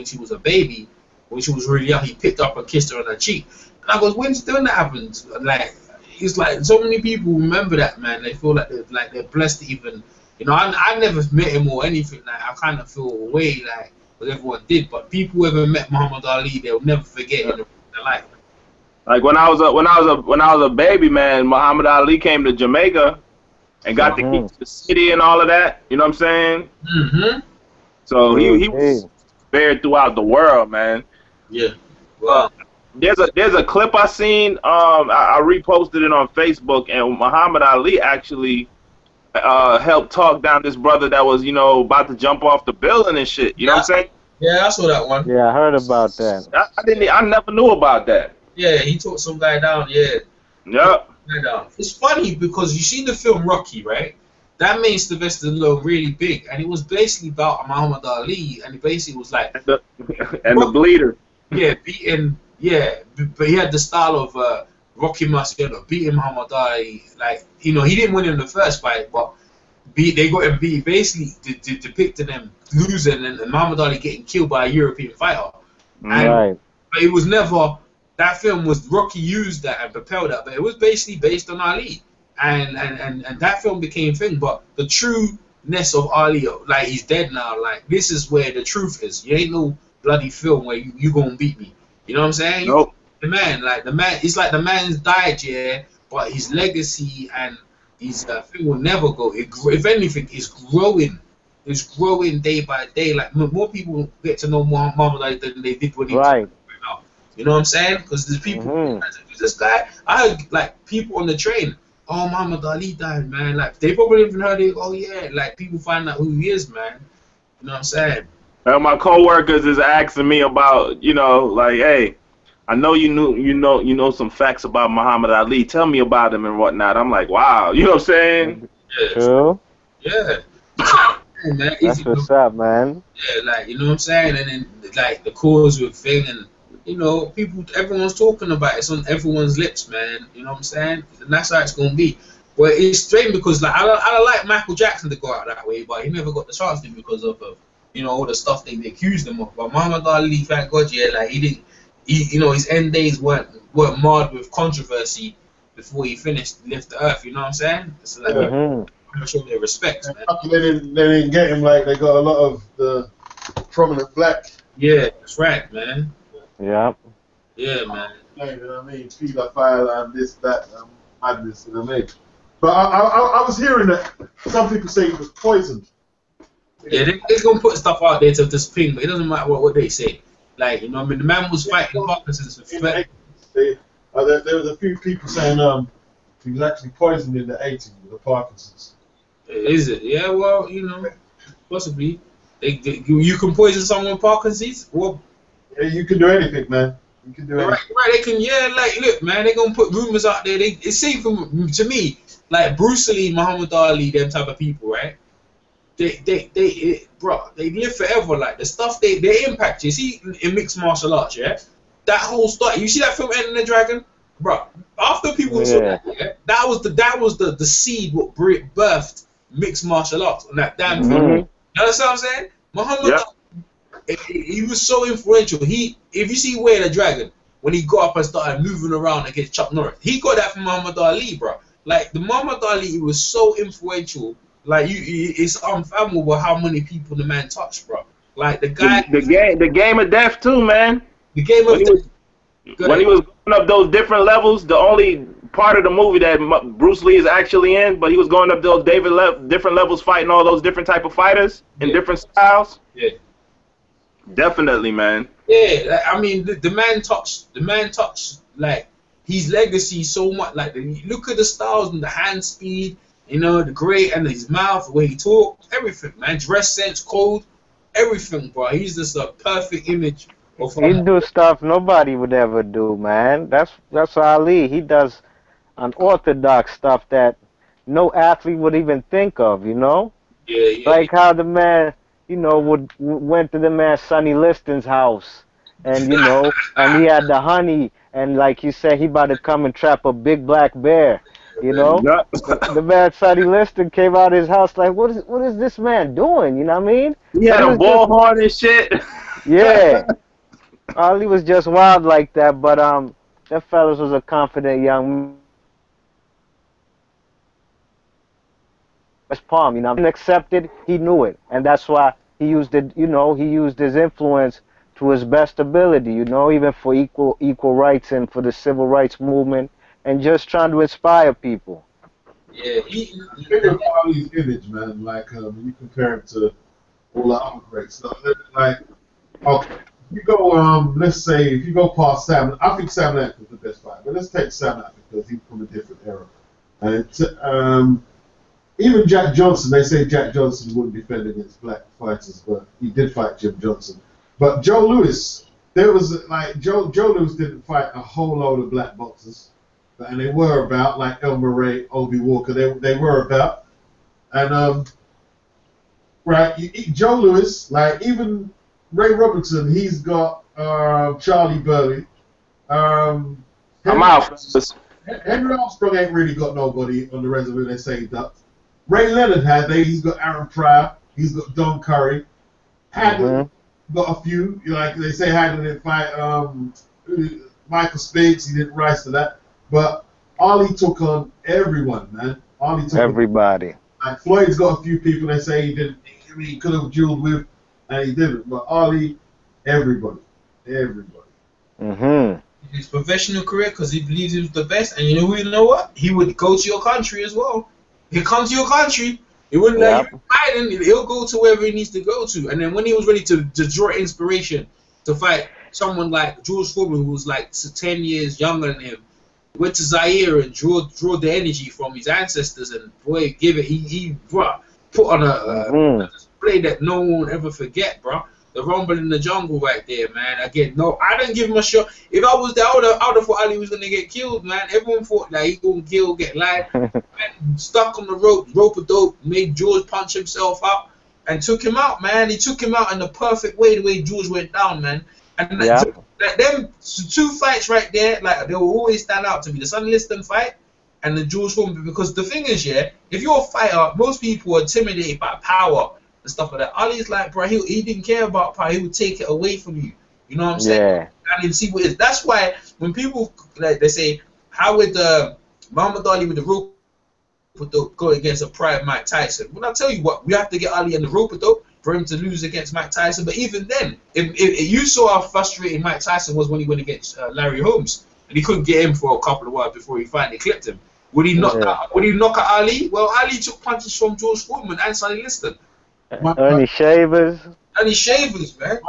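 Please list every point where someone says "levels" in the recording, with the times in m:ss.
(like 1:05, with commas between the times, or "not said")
4:04, 4:09.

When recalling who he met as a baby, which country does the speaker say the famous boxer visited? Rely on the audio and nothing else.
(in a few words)
Jamaica.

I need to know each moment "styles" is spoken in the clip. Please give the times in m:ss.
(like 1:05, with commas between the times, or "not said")
1:03, 4:12, 4:21.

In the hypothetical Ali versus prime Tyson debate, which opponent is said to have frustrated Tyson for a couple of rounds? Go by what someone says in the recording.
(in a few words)
Larry Holmes.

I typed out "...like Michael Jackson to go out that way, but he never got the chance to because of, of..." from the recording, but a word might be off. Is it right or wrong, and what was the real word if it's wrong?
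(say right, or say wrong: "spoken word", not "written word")
right.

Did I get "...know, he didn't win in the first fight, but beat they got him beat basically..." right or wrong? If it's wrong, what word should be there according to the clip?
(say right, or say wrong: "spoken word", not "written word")
right.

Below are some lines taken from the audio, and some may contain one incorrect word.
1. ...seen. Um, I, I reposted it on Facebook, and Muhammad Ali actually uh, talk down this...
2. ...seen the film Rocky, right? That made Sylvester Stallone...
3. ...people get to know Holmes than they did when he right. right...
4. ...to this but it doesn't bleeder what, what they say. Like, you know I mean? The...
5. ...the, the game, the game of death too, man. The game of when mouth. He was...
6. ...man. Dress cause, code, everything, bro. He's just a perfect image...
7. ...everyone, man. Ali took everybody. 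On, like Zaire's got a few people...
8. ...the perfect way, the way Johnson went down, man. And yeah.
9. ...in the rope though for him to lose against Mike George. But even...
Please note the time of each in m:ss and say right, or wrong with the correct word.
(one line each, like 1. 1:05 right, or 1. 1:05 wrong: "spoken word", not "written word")
1. 0:34 right
2. 0:52 right
3. 1:43 wrong: "Muhammad", not "Holmes"
4. 2:58 wrong: "matter", not "bleeder"
5. 3:59 wrong: "death", not "mouth"
6. 4:26 wrong: "sense", not "cause"
7. 6:21 wrong: "Floyd", not "Zaire"
8. 7:12 wrong: "George", not "Johnson"
9. 7:40 wrong: "Tyson", not "George".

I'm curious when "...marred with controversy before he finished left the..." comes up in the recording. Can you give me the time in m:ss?
2:34.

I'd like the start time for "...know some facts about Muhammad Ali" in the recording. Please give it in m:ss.
2:03.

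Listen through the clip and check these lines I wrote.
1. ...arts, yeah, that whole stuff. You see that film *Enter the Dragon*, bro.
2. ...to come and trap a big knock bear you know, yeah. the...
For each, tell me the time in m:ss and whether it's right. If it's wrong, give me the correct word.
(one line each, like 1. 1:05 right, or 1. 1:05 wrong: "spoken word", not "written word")
1. 3:31 right
2. 4:49 wrong: "black", not "knock".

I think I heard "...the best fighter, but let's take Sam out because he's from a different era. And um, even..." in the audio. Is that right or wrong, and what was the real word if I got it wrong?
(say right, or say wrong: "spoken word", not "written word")
right.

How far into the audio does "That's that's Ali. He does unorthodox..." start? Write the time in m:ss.
4:33.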